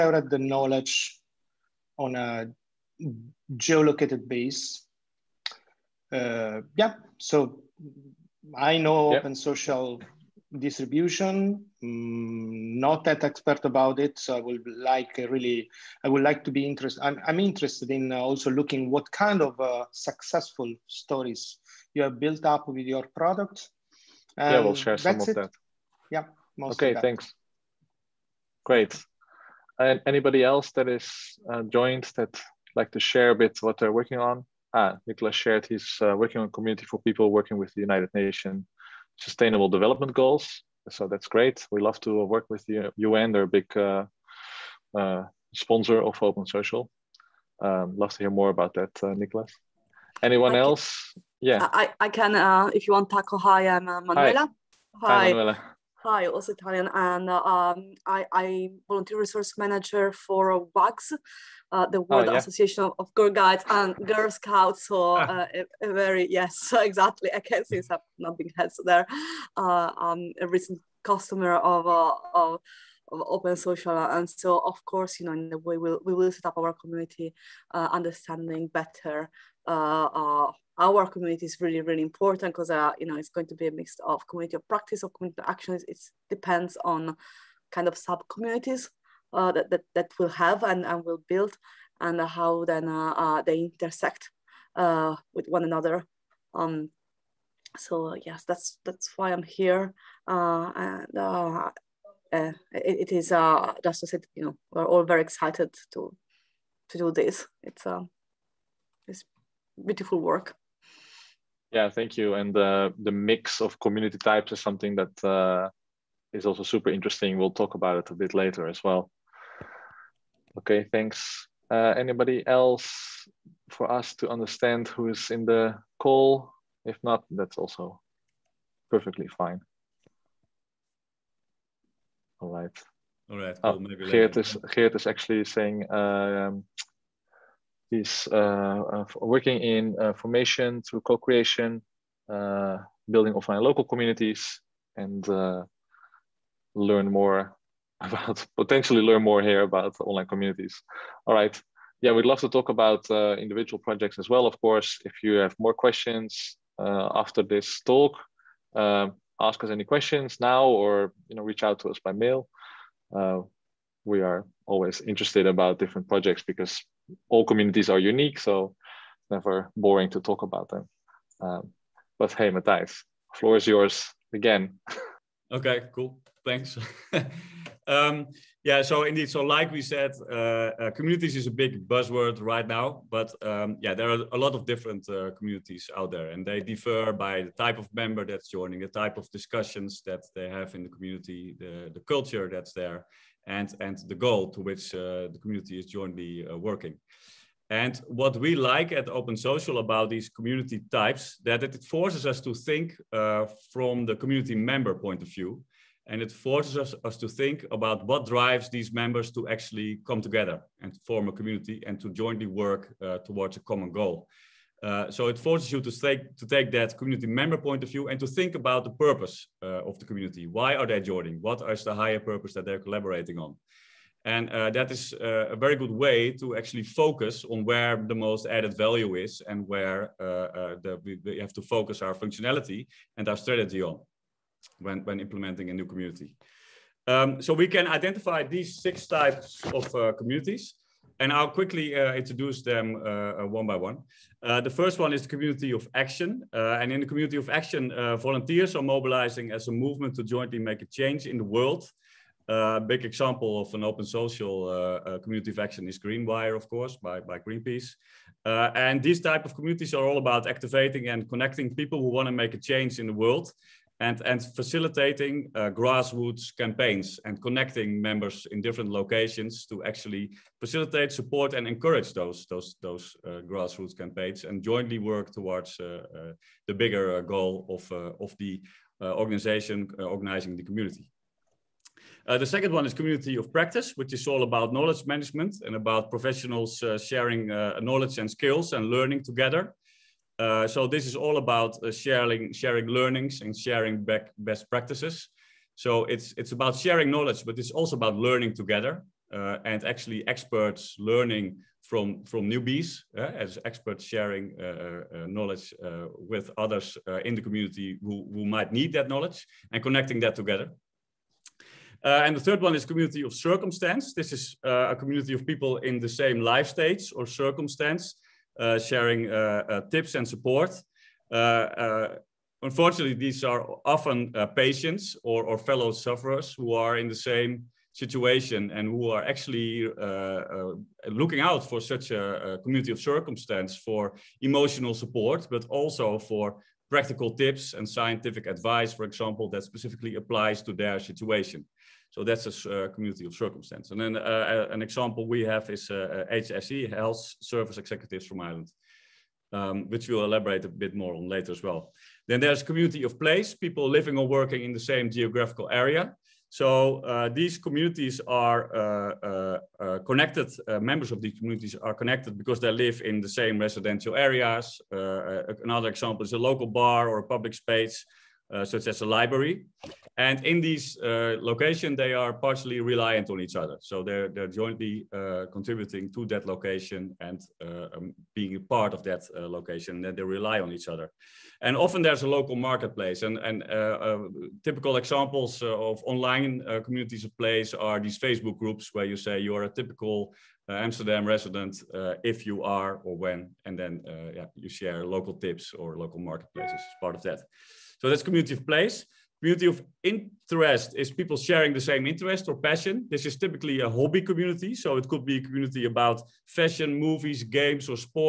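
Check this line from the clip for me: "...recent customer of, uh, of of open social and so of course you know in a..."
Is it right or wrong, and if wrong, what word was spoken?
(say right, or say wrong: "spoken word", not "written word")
right.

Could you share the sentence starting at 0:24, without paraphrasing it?
And yeah, we'll share some of it.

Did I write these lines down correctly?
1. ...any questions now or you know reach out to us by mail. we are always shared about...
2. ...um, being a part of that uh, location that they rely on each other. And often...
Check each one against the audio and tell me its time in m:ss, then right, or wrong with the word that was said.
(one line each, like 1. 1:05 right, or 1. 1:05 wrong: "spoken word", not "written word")
1. 2:39 wrong: "interested", not "shared"
2. 6:17 right.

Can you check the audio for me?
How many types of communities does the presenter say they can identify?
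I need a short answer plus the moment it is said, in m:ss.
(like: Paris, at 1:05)
6, at 3:58.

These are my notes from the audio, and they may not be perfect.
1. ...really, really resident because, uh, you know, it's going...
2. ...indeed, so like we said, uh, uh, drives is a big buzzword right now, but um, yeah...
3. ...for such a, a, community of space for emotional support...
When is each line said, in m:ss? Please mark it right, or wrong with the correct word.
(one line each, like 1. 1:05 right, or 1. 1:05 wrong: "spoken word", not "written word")
1. 1:21 wrong: "important", not "resident"
2. 2:59 wrong: "communities", not "drives"
3. 5:31 wrong: "circumstance", not "space".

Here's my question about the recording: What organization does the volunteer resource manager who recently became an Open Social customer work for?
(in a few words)
WAGGGS.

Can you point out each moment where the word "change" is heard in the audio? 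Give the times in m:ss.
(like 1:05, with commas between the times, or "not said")
4:10, 4:22.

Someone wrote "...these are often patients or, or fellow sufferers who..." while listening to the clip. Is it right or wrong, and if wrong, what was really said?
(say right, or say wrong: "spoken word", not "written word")
right.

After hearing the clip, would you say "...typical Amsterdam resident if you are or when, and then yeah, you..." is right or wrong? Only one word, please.
right.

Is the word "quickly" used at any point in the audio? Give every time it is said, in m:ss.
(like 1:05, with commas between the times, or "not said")
4:01.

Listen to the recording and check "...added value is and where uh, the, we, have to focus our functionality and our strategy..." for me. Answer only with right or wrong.
right.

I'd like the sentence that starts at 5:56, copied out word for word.
So uh, these communities are uh, uh, connected, members of these communities are connected because they live in the same residential areas.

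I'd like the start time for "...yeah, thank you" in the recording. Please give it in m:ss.
1:51.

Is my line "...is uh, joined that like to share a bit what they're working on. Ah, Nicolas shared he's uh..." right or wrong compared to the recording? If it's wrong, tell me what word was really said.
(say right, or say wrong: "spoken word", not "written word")
right.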